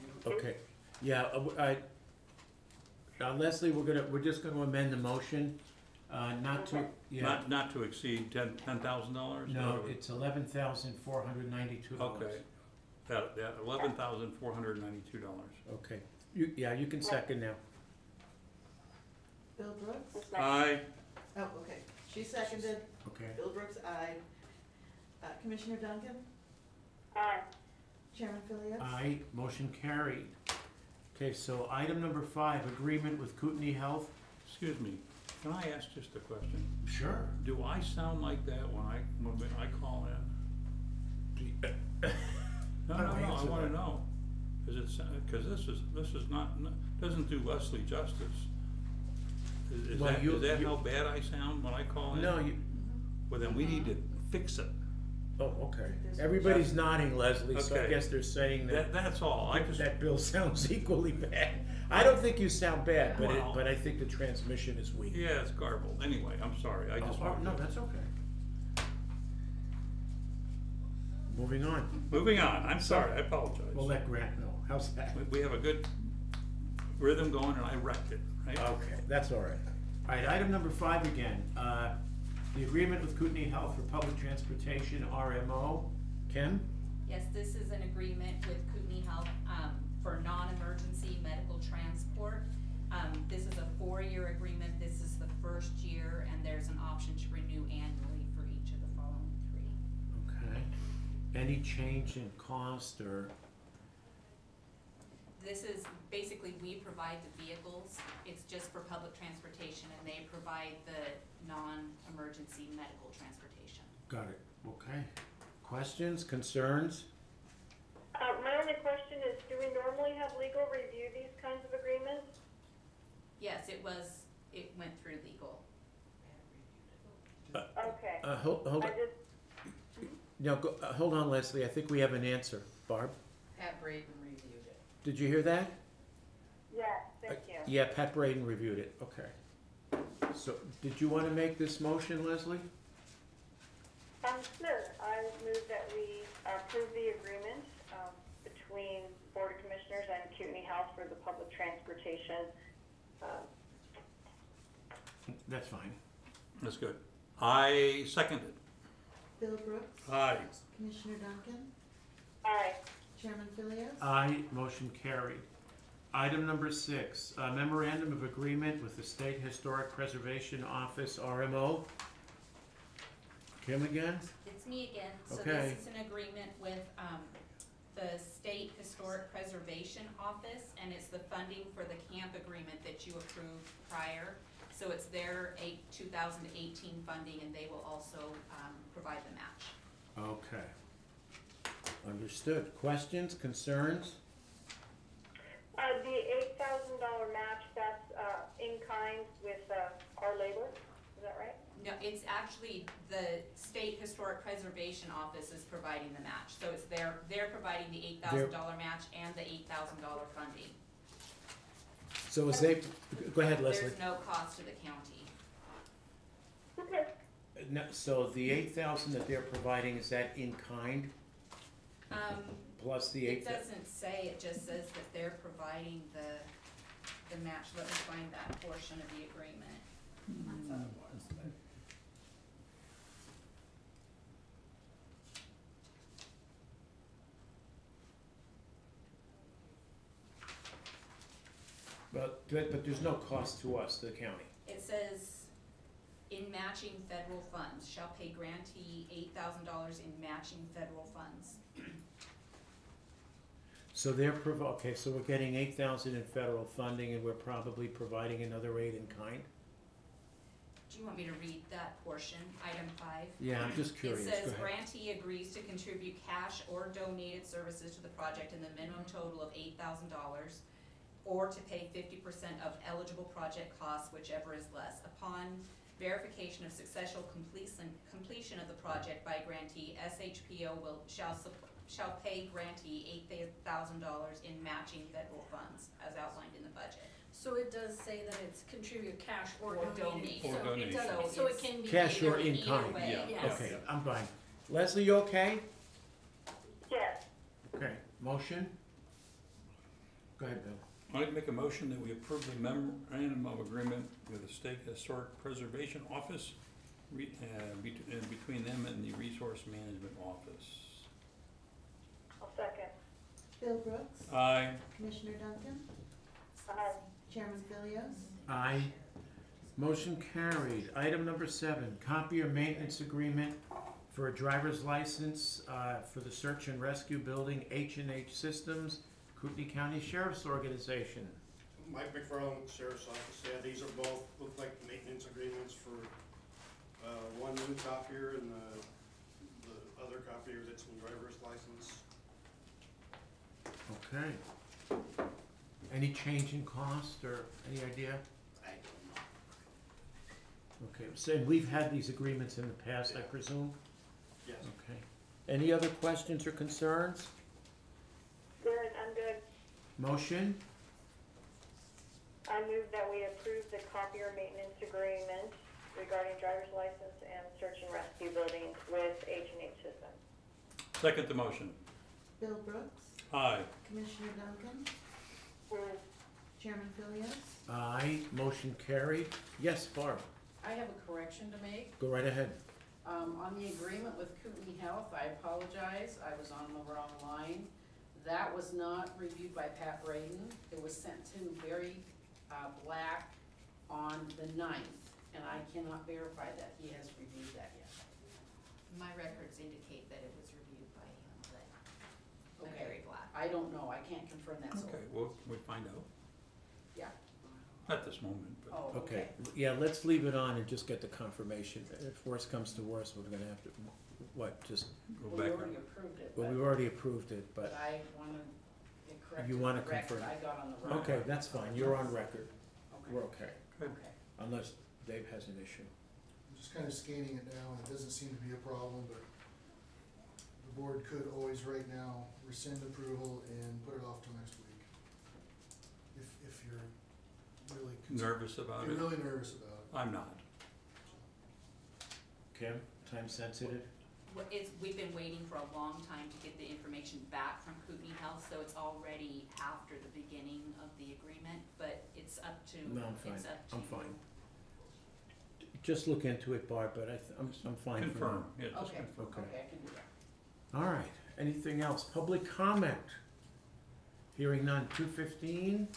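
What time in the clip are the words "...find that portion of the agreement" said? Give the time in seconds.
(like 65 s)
227 s.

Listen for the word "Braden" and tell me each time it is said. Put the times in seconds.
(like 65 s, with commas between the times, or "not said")
133 s, 138 s, 390 s.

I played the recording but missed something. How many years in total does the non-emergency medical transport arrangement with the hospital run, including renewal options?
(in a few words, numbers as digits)
4.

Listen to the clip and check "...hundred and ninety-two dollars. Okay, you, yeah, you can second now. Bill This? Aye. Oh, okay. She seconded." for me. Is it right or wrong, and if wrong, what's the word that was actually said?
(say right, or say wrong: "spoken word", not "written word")
wrong: "Brooks", not "This".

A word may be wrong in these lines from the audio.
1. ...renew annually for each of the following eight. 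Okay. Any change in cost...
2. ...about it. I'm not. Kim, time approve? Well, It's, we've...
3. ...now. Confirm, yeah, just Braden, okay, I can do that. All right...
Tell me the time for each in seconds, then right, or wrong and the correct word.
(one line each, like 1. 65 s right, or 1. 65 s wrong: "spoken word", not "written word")
1. 97 s wrong: "three", not "eight"
2. 439 s wrong: "sensitive", not "approve"
3. 458 s wrong: "Okay", not "Braden".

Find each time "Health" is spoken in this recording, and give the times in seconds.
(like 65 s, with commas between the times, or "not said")
33 s, 83 s, 89 s, 150 s, 384 s, 448 s.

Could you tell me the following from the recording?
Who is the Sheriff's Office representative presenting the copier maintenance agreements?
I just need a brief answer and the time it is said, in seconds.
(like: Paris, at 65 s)
Mike McFarland, at 331 s.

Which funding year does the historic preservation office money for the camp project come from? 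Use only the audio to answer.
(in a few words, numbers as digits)
2018.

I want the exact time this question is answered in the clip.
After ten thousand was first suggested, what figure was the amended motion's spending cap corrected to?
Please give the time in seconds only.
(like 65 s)
10 s.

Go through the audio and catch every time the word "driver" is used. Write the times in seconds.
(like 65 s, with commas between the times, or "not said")
324 s, 340 s, 366 s.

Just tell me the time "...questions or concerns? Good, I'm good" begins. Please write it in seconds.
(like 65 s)
356 s.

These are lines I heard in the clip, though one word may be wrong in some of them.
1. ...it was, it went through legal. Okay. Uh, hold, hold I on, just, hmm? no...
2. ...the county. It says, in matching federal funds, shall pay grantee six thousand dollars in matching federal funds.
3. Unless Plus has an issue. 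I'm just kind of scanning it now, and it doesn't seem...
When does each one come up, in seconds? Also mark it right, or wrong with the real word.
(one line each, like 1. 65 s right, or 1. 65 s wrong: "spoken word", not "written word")
1. 123 s right
2. 243 s wrong: "eight", not "six"
3. 424 s wrong: "Dave", not "Plus".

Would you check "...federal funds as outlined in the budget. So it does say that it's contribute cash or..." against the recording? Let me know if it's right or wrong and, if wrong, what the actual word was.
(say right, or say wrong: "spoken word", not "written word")
right.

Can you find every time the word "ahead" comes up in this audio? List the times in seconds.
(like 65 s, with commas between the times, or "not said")
213 s, 264 s, 300 s, 382 s.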